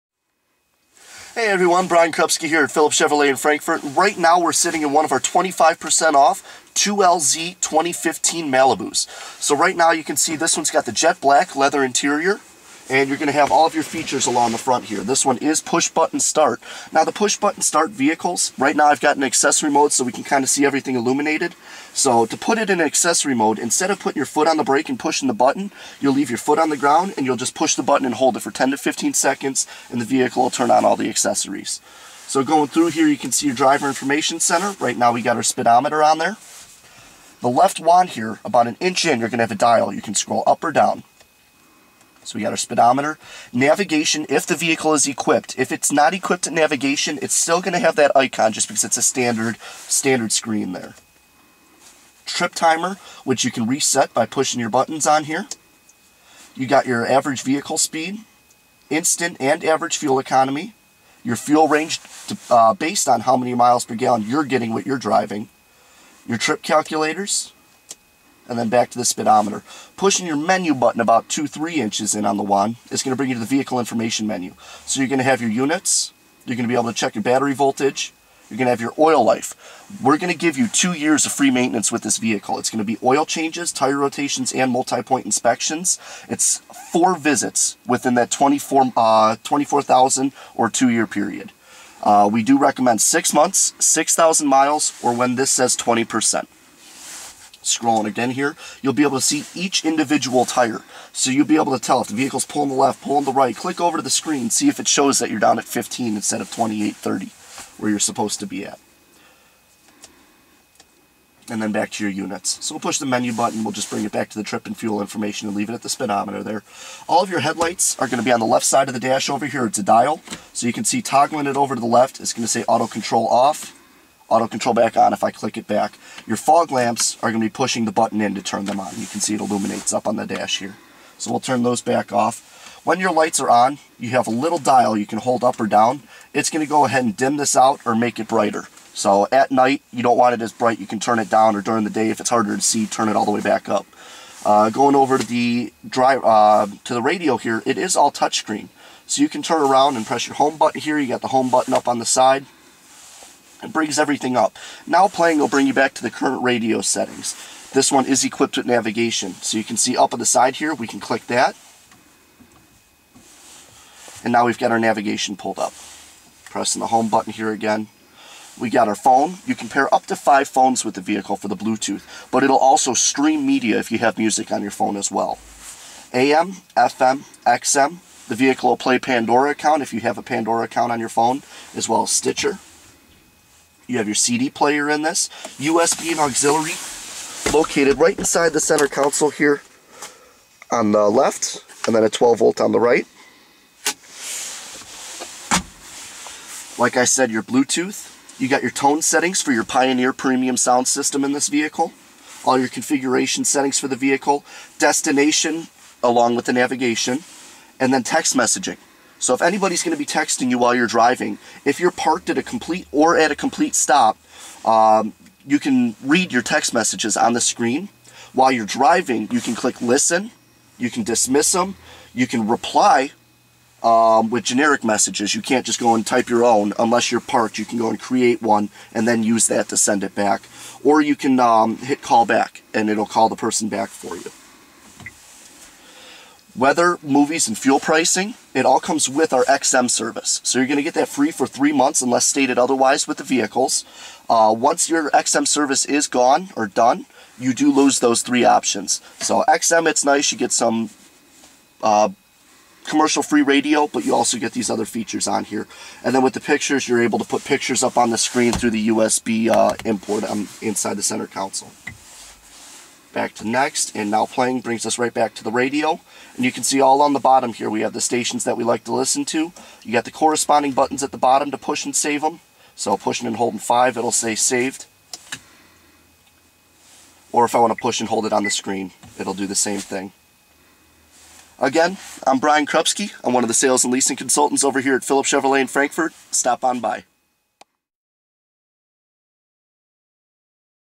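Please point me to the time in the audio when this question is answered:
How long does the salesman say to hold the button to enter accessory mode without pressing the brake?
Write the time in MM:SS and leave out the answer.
00:28.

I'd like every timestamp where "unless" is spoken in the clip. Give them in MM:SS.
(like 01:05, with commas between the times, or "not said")
03:46, 04:02.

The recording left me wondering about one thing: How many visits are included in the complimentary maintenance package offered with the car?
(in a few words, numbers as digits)
4.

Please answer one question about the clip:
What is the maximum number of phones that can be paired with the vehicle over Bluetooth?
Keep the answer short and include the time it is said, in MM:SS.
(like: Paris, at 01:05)
5, at 02:49.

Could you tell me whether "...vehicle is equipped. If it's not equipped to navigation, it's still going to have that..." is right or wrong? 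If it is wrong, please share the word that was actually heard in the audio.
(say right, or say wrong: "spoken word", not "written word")
right.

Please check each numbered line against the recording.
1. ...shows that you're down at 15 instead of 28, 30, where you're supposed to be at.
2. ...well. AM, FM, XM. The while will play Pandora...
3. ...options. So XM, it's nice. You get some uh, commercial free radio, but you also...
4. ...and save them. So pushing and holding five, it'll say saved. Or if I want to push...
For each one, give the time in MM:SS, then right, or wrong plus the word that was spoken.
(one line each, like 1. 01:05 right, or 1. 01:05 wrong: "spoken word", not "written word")
1. 01:44 right
2. 02:55 wrong: "vehicle", not "while"
3. 04:08 right
4. 04:31 right.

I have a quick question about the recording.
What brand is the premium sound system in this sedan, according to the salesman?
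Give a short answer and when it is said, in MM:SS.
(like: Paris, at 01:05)
Pioneer, at 03:19.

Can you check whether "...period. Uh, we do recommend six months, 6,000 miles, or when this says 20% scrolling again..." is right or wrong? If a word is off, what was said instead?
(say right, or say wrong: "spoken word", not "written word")
right.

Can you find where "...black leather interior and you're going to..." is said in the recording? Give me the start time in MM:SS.
00:11.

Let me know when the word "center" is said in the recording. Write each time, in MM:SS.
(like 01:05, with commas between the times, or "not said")
00:34, 03:08, 04:21.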